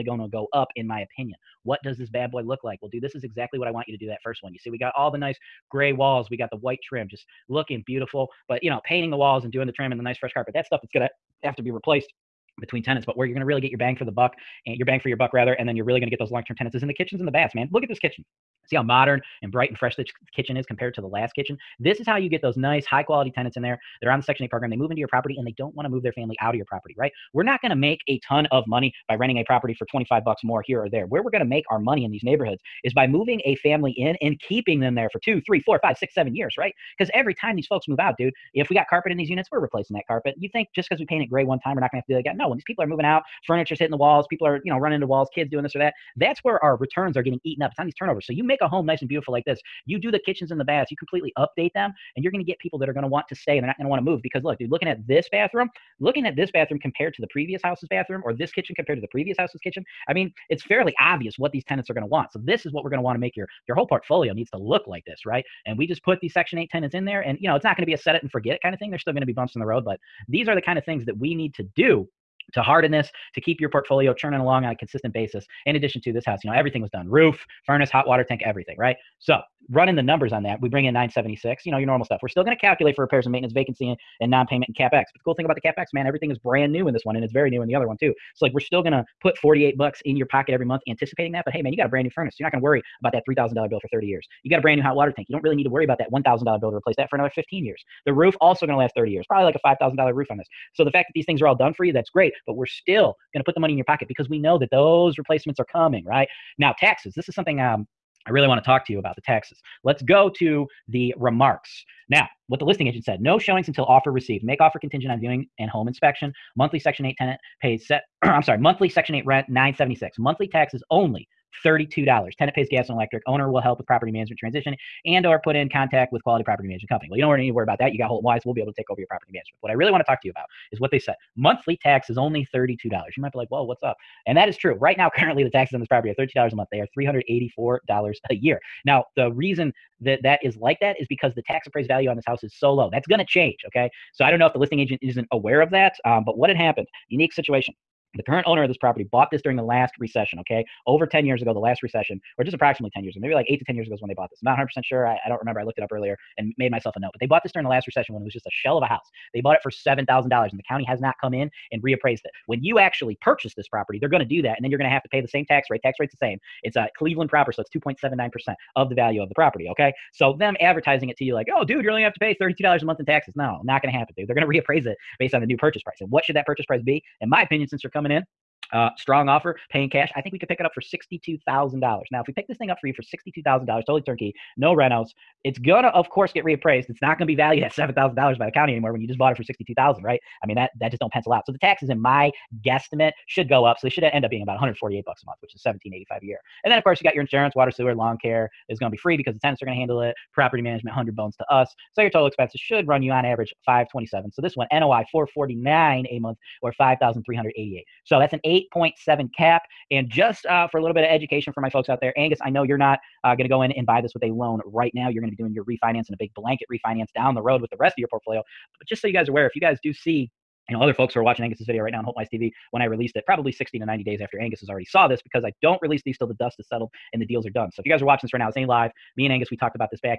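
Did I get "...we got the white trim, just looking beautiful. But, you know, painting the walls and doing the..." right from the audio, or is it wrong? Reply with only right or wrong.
right.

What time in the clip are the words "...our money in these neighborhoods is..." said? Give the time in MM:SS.
00:31.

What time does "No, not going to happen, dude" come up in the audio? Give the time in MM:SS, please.
02:53.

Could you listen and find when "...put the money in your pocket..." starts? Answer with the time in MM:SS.
01:43.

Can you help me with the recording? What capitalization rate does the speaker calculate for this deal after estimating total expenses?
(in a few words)
8.7 cap.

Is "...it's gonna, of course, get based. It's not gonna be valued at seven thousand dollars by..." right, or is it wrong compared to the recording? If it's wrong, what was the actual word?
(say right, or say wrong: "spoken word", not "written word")
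wrong: "reappraised", not "based".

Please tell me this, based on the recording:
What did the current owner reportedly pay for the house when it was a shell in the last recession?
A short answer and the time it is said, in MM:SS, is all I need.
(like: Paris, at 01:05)
$7,000, at 02:39.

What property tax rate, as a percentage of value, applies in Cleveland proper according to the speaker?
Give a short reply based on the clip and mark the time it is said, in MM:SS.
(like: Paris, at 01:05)
2.79%, at 02:47.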